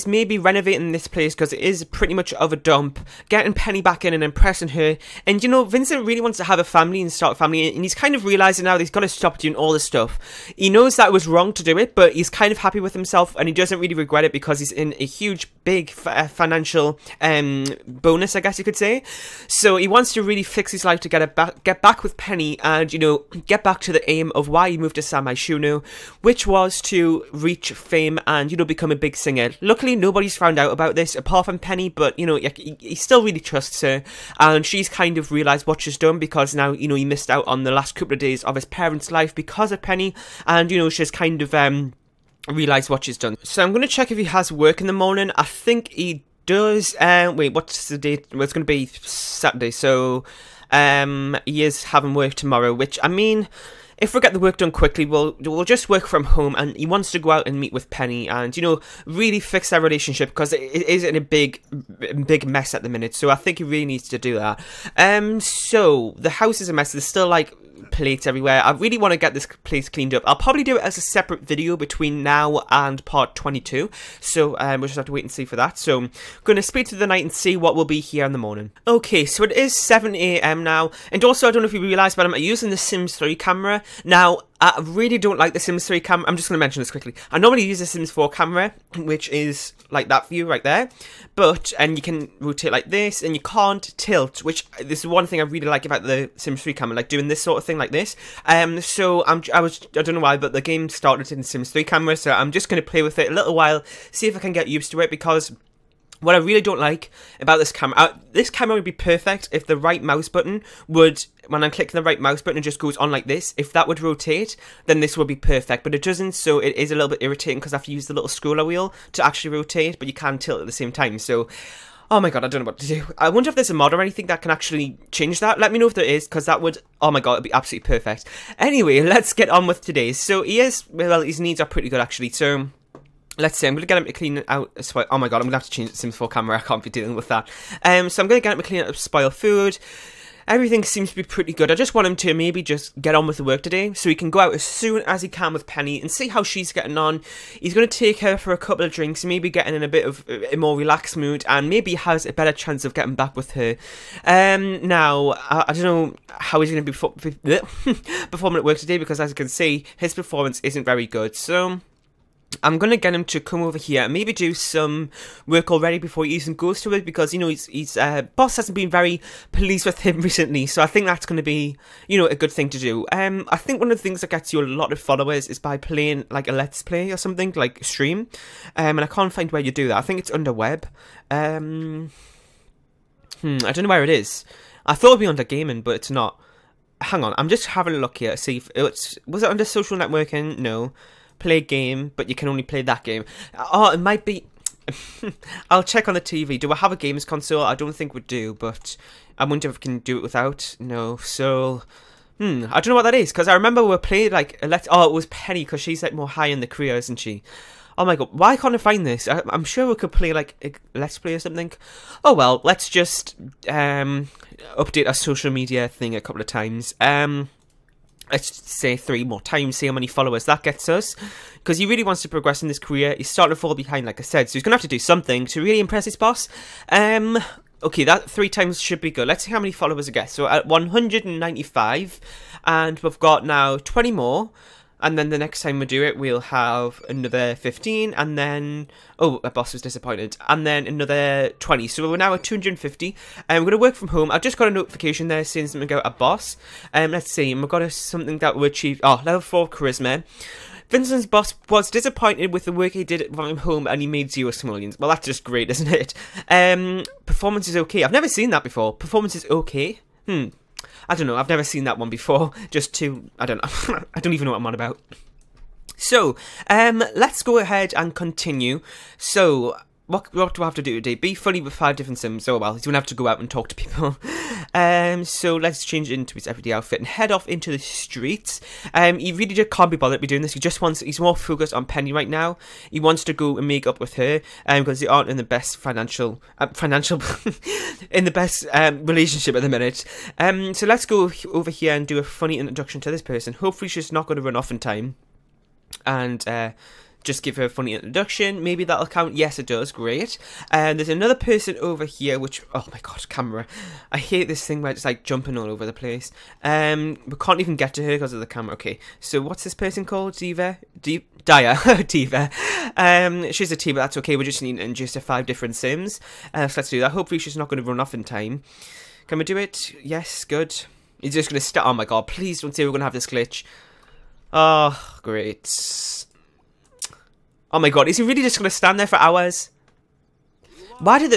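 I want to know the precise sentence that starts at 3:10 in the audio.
No play a game, but you can only play that game.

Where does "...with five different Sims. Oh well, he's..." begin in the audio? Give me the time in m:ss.
4:31.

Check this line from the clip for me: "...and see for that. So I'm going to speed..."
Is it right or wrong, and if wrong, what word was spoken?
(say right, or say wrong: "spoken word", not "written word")
right.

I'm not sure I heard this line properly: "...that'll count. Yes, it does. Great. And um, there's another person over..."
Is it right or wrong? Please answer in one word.
right.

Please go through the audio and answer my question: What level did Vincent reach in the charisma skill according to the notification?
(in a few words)
Level 4.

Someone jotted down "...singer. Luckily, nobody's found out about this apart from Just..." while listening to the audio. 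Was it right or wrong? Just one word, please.
wrong.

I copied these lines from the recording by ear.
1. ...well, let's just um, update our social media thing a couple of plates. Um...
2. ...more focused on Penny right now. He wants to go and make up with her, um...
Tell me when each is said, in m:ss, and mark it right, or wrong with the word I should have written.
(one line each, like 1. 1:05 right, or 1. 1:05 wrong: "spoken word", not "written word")
1. 3:32 wrong: "times", not "plates"
2. 4:41 right.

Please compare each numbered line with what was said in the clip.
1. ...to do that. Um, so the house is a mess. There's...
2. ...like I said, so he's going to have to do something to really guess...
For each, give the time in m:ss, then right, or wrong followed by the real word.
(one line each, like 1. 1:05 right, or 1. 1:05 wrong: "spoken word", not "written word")
1. 1:04 right
2. 3:44 wrong: "impress", not "guess".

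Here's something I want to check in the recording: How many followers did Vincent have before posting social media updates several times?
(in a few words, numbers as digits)
195.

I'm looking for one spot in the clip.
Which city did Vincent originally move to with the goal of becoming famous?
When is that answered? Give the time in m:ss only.
0:25.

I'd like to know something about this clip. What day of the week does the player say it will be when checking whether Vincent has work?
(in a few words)
Saturday.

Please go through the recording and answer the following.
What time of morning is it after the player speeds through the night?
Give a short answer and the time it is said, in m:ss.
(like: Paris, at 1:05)
7am, at 1:19.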